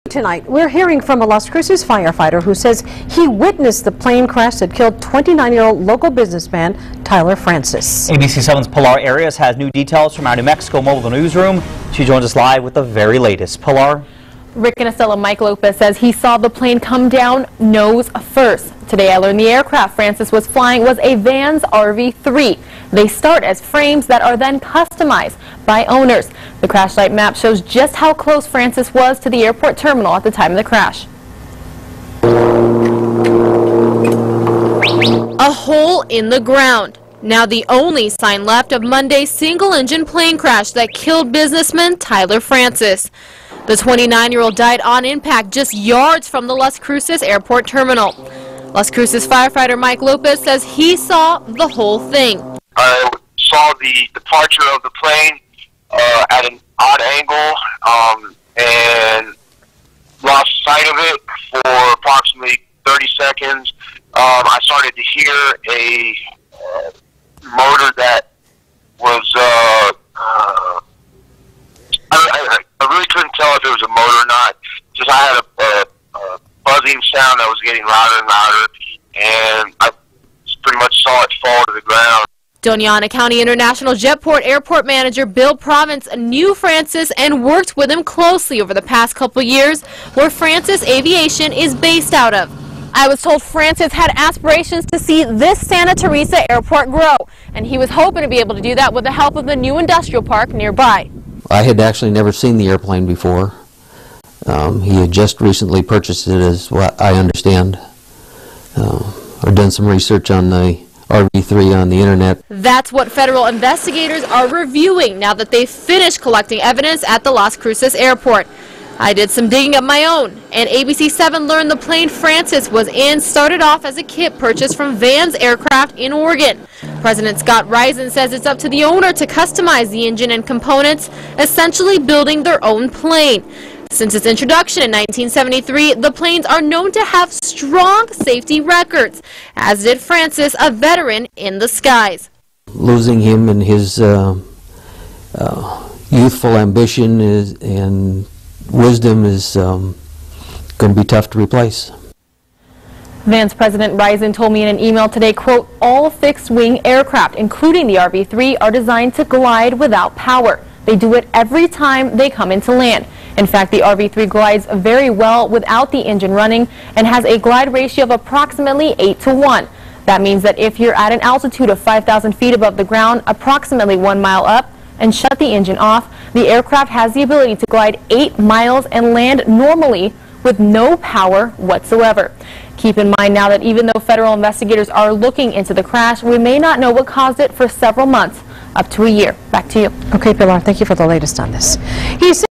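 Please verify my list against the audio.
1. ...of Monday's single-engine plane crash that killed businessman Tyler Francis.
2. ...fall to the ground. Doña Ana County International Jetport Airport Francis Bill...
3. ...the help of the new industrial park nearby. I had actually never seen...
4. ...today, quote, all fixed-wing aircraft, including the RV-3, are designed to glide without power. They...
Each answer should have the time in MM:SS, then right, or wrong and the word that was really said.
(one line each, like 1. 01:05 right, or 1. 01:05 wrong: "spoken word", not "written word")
1. 00:38 right
2. 01:21 wrong: "Manager", not "Francis"
3. 01:39 right
4. 02:35 right.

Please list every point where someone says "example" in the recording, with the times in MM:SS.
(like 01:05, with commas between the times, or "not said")
not said.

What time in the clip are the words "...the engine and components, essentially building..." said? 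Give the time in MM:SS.
02:09.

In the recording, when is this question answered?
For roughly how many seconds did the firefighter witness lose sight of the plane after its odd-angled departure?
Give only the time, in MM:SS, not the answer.
01:01.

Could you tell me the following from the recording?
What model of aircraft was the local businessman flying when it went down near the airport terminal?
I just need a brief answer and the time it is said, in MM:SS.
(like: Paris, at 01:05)
Vans RV-3, at 00:21.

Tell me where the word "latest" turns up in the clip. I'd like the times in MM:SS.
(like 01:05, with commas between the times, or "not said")
00:13, 03:11.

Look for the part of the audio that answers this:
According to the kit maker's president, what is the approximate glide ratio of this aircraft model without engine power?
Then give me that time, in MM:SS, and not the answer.
02:48.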